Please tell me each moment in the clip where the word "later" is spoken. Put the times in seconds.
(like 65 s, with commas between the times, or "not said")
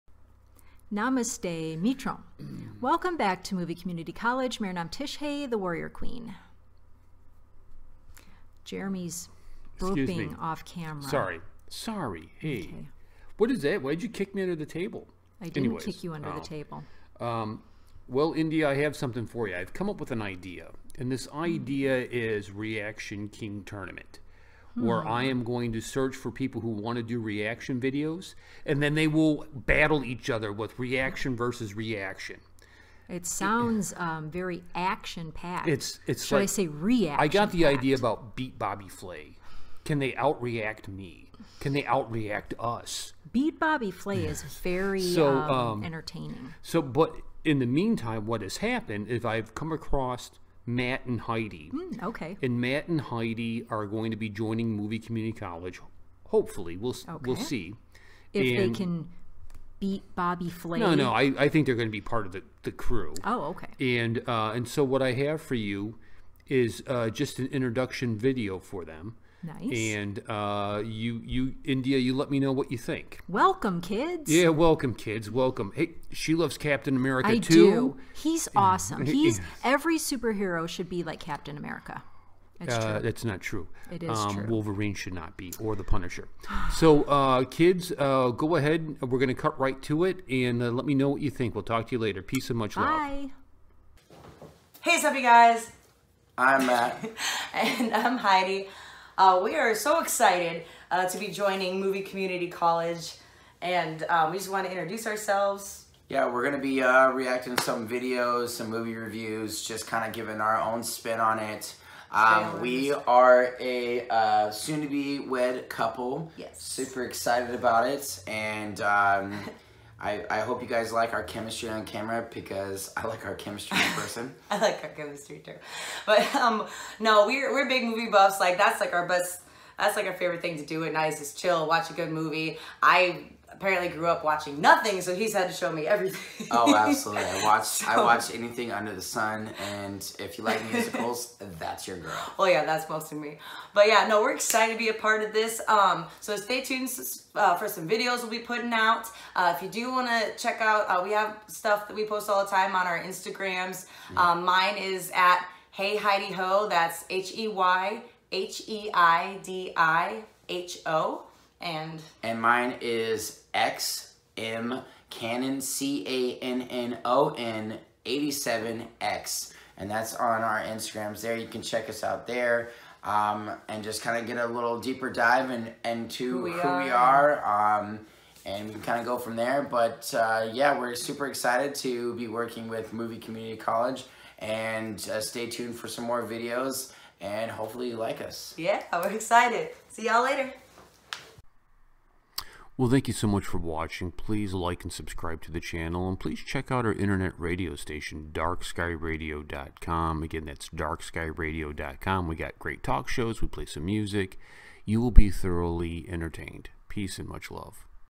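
91 s, 190 s.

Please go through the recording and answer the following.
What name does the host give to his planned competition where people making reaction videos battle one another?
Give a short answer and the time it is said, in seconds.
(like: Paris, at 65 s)
Reaction King Tournament, at 22 s.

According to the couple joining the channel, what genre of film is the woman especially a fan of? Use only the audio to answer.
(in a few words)
musicals.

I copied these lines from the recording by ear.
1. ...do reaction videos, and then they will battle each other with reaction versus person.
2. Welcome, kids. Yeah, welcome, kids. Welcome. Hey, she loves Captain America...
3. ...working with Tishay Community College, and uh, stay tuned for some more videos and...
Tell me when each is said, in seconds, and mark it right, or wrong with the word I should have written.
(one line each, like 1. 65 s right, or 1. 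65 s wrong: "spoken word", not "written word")
1. 27 s wrong: "reaction", not "person"
2. 73 s right
3. 182 s wrong: "Movie", not "Tishay".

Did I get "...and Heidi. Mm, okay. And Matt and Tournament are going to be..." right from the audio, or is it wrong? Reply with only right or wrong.
wrong.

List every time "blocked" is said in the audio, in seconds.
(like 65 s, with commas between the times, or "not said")
not said.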